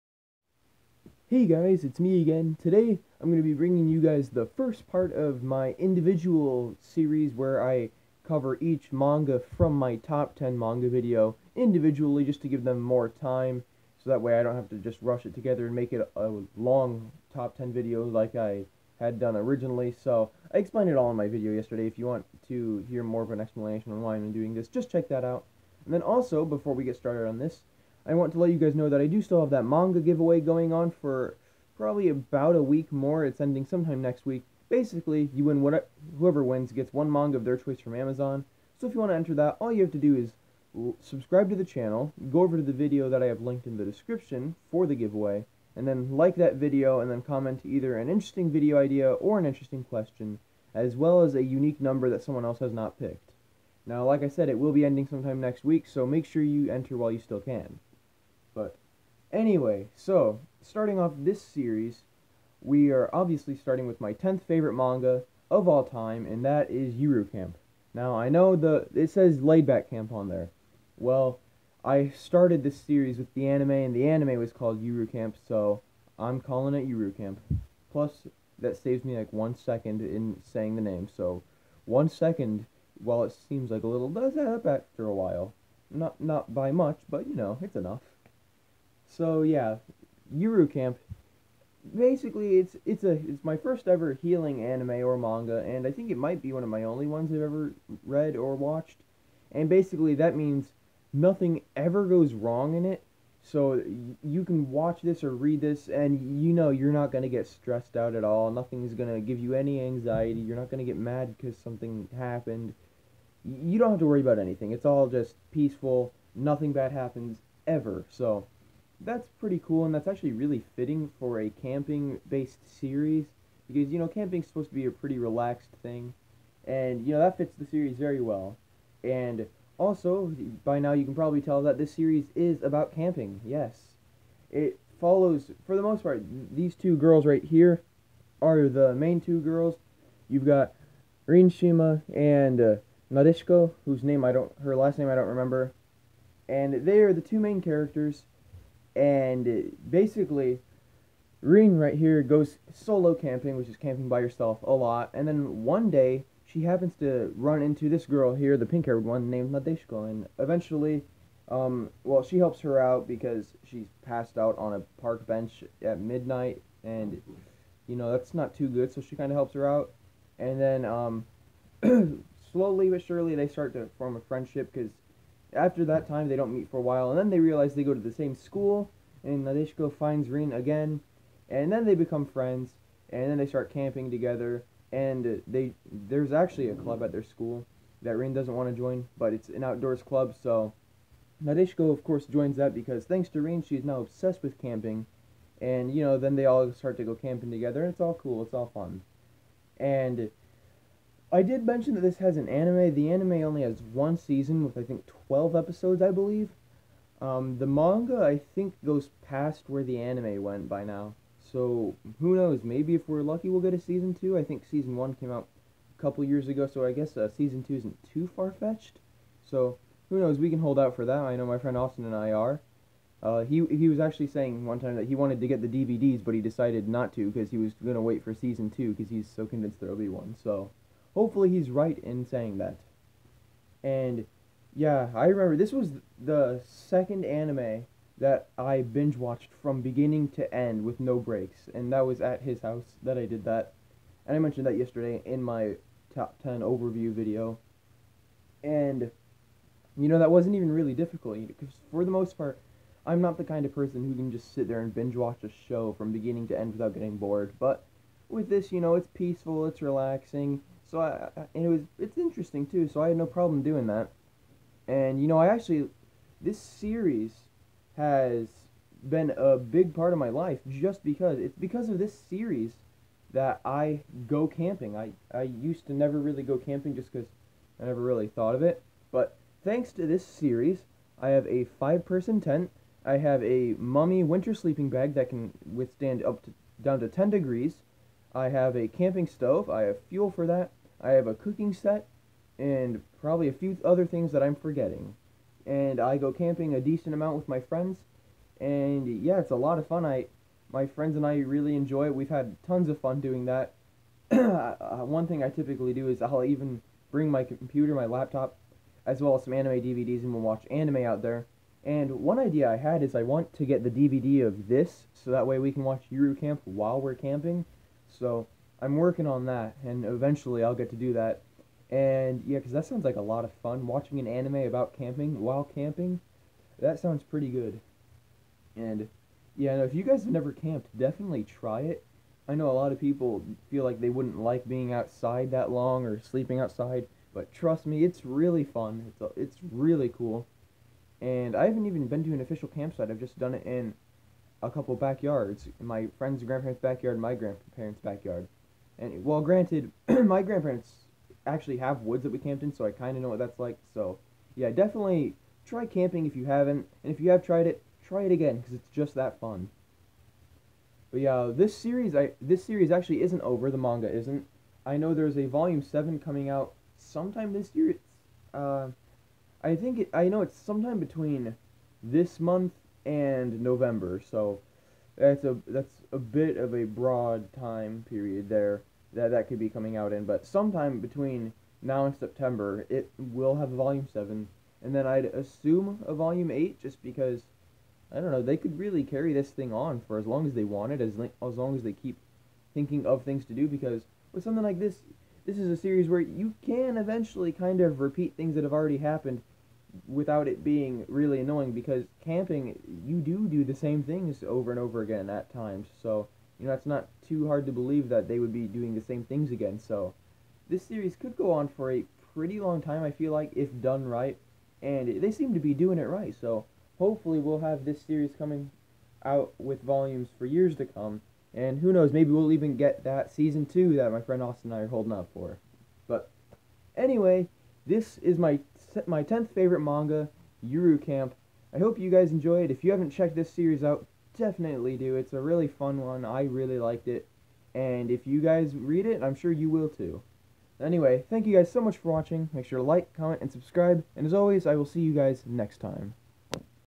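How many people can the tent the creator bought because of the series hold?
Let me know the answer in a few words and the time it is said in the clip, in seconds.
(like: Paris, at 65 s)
5, at 281 s.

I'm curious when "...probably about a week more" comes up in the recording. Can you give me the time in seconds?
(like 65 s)
31 s.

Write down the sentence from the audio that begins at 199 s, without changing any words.
And I did mention that this has an anime.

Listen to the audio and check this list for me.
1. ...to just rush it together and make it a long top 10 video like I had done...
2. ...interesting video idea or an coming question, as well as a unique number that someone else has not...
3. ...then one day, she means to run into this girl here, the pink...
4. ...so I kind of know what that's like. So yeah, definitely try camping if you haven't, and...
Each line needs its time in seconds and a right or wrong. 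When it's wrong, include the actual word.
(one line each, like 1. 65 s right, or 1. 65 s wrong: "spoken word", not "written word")
1. 14 s right
2. 48 s wrong: "interesting", not "coming"
3. 155 s wrong: "happens", not "means"
4. 352 s right.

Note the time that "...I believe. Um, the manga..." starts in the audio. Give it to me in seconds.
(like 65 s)
206 s.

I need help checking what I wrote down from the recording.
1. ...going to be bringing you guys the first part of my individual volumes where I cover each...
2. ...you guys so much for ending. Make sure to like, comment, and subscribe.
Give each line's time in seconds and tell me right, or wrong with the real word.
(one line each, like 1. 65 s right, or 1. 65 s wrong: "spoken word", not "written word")
1. 3 s wrong: "series", not "volumes"
2. 441 s wrong: "watching", not "ending".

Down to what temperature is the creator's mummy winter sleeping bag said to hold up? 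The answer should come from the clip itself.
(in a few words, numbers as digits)
10 degrees.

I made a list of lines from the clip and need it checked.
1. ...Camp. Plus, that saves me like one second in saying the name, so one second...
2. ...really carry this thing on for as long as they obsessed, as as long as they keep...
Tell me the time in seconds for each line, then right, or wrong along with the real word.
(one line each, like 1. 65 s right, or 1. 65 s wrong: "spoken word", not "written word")
1. 77 s right
2. 388 s wrong: "wanted", not "obsessed".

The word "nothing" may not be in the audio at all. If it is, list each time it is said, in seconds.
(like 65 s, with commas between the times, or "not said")
101 s, 108 s, 116 s.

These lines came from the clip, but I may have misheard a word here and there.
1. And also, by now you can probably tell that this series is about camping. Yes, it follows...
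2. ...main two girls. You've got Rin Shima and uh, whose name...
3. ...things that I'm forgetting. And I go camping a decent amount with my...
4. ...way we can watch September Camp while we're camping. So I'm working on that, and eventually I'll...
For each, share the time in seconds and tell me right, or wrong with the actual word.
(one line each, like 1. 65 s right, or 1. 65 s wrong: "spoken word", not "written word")
1. 129 s right
2. 138 s right
3. 294 s right
4. 315 s wrong: "Yuru", not "September".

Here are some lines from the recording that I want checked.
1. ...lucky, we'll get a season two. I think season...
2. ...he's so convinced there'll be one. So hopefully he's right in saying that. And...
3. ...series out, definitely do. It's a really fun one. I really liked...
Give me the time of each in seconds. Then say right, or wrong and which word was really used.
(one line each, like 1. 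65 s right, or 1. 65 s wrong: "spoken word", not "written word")
1. 213 s right
2. 229 s right
3. 433 s right.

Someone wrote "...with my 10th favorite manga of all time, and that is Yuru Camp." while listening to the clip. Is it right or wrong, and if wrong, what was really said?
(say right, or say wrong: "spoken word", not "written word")
right.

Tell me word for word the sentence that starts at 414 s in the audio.
And they seem to be doing it right.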